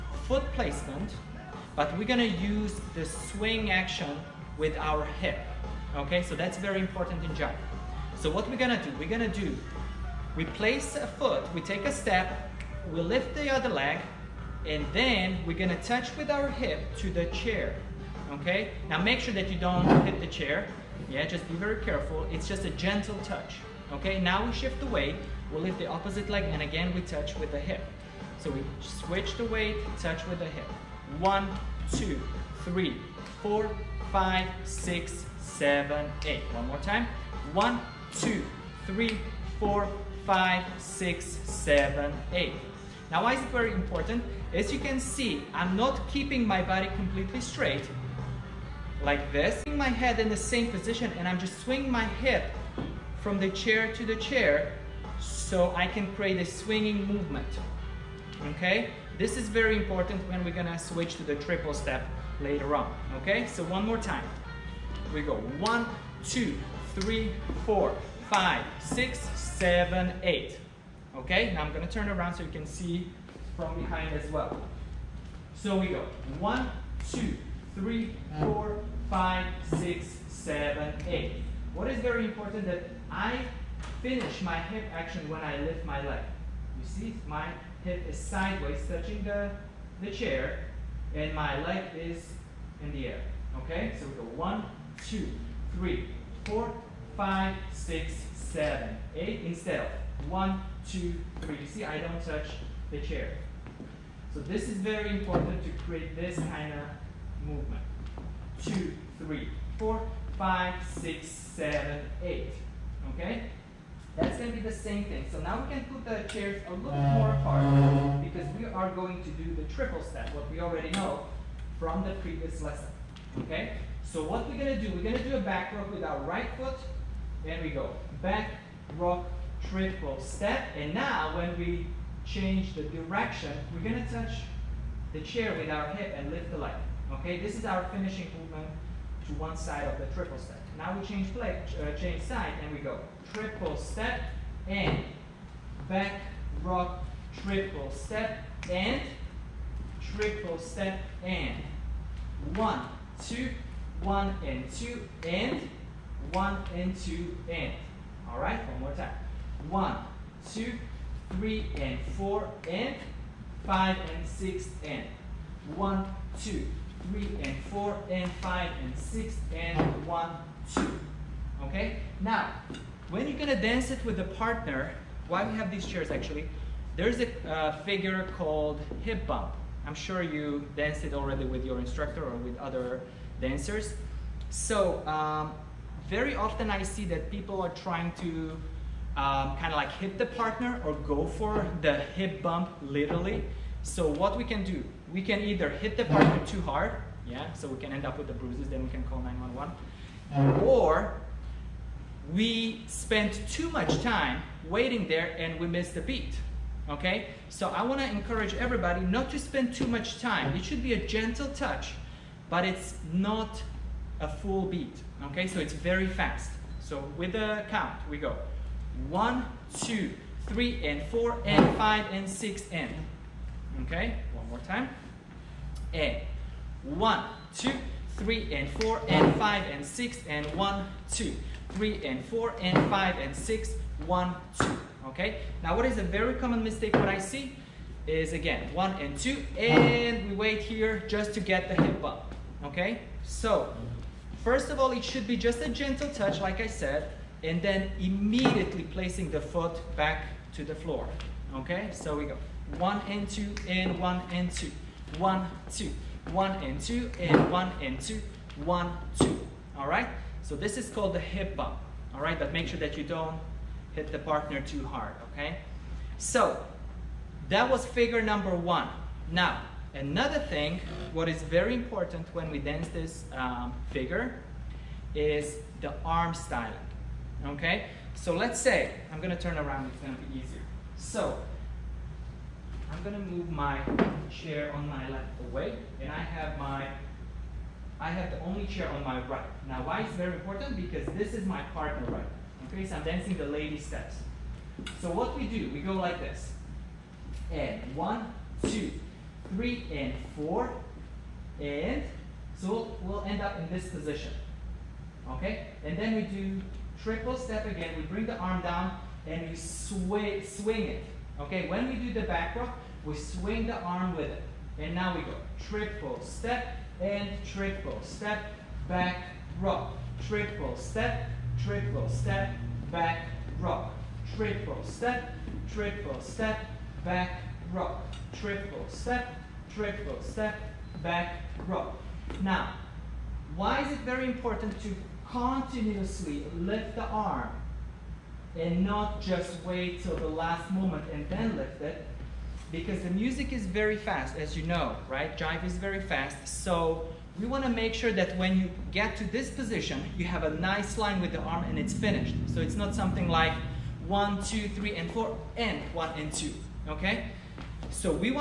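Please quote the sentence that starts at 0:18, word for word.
Now make sure that you don't hit the chair.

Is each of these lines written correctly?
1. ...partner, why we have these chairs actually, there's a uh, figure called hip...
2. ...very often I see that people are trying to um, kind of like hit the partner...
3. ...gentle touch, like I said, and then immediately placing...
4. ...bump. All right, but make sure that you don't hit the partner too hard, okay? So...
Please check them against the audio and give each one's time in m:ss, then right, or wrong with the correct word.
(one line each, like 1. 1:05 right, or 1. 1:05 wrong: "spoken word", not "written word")
1. 2:54 right
2. 3:06 right
3. 4:05 right
4. 4:21 right.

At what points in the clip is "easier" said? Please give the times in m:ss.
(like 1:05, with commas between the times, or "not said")
4:40.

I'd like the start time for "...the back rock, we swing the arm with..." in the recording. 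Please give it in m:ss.
5:12.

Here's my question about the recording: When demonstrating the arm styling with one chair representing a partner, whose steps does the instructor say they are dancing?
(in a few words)
The lady steps.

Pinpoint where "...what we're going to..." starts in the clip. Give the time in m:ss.
2:04.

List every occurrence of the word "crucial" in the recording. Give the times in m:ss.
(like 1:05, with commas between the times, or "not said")
not said.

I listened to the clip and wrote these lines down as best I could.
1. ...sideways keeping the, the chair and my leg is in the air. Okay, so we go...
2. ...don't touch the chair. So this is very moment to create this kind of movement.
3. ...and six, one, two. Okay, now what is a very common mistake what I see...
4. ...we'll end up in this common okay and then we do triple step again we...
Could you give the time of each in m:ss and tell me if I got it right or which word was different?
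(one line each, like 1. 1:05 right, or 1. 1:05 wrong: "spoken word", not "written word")
1. 1:28 wrong: "touching", not "keeping"
2. 1:41 wrong: "important", not "moment"
3. 3:53 right
4. 5:03 wrong: "position", not "common".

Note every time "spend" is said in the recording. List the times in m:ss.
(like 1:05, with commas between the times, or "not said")
3:22, 3:29.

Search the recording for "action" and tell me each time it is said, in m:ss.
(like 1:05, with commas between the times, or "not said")
0:03, 1:24.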